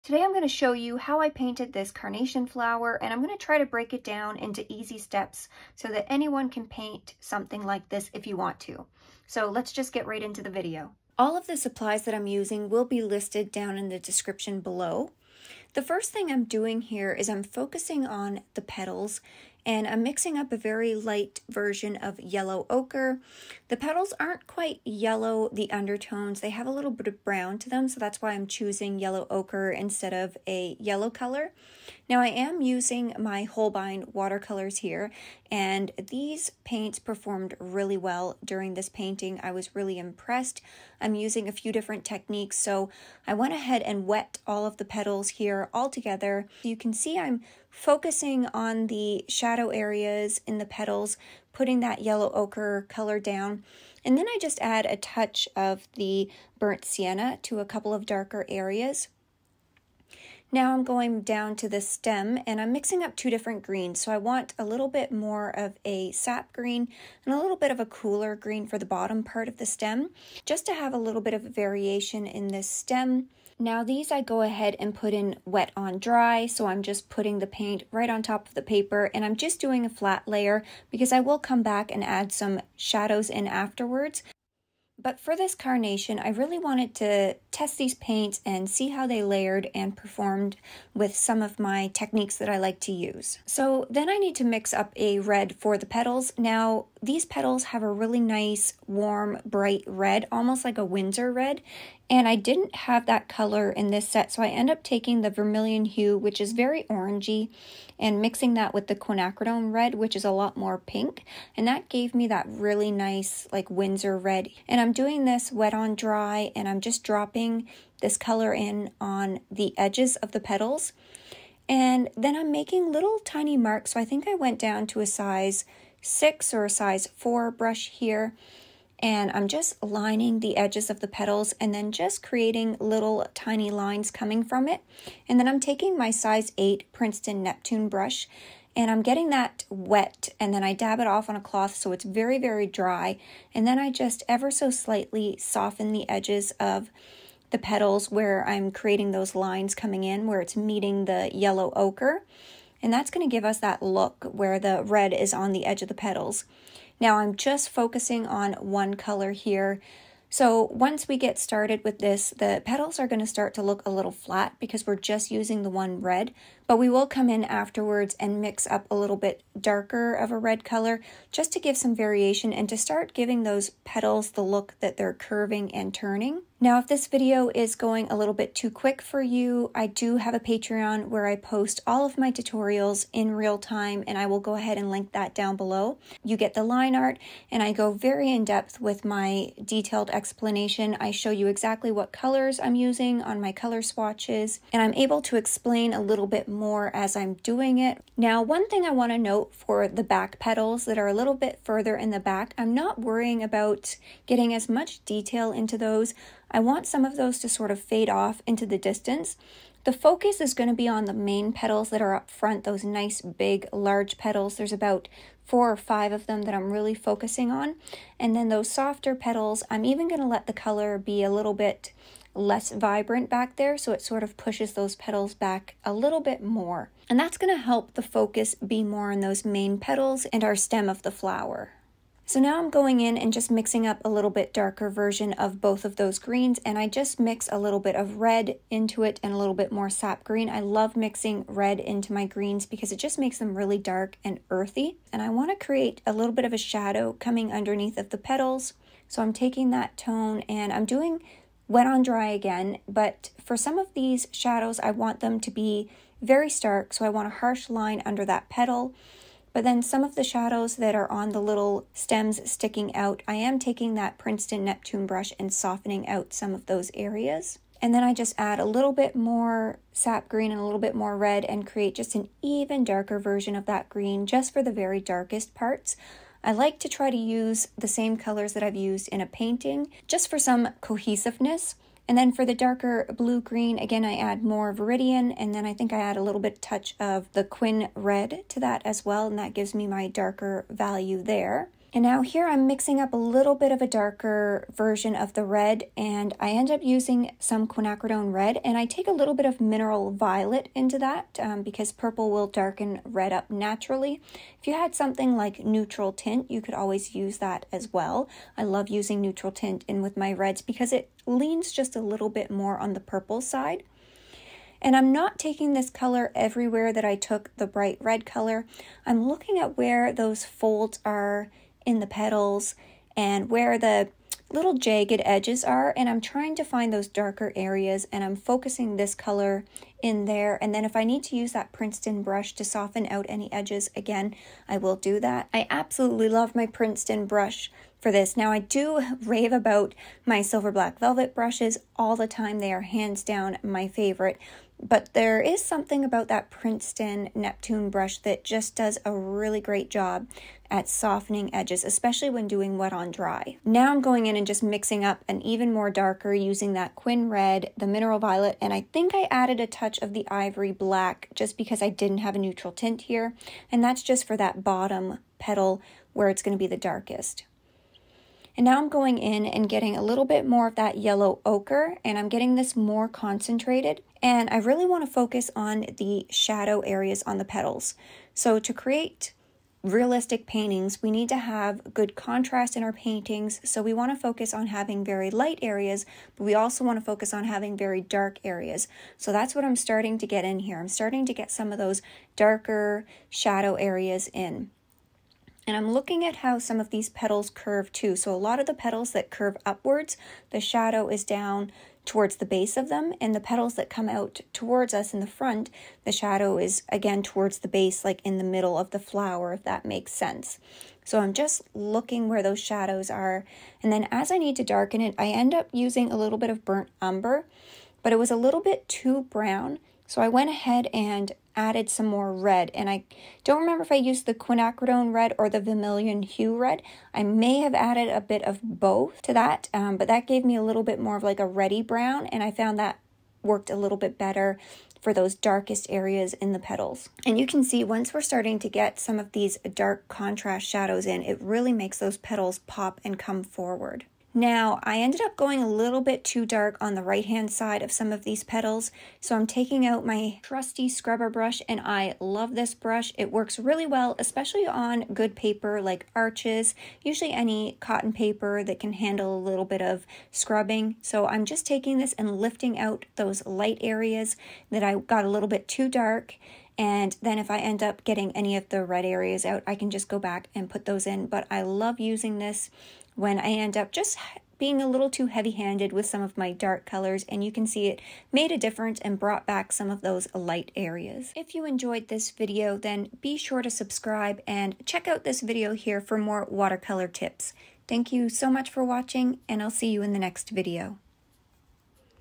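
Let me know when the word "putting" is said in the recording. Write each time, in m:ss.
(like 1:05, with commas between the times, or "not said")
0:51, 1:17.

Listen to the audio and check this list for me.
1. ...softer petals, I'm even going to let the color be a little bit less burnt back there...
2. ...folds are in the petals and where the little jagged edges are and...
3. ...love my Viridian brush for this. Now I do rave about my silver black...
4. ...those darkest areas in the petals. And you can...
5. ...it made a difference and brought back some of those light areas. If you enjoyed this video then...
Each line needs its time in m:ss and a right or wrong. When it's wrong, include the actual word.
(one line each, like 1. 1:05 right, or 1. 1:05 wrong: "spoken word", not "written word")
1. 3:38 wrong: "vibrant", not "burnt"
2. 5:20 right
3. 5:36 wrong: "Princeton", not "Viridian"
4. 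7:15 right
5. 7:57 right.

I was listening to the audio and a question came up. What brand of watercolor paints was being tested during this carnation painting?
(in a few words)
Holbein.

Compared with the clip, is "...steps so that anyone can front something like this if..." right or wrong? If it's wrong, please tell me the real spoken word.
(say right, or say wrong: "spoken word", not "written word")
wrong: "paint", not "front".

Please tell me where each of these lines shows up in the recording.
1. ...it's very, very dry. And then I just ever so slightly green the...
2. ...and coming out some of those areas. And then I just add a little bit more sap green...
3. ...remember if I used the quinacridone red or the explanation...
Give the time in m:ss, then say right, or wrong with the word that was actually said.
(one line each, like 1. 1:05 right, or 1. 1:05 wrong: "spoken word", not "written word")
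1. 2:21 wrong: "soften", not "green"
2. 4:25 wrong: "softening", not "coming"
3. 7:03 wrong: "vermilion", not "explanation".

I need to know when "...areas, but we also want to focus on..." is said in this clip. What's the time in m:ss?
6:25.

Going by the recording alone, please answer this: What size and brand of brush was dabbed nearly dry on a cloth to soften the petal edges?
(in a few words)
Size 8 Princeton Neptune.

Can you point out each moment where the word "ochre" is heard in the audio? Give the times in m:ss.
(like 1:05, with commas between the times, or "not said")
0:22, 0:29, 0:52, 2:31, 6:11.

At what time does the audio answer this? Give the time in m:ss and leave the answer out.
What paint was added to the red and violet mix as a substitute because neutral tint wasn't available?
6:00.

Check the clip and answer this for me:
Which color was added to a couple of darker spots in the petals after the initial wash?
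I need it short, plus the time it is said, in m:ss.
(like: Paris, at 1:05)
Burnt sienna, at 0:56.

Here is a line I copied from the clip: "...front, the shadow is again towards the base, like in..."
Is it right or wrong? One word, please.
right.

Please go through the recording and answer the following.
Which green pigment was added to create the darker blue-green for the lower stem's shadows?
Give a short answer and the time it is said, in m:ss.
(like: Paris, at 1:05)
Viridian, at 4:44.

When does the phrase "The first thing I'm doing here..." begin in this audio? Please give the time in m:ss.
0:15.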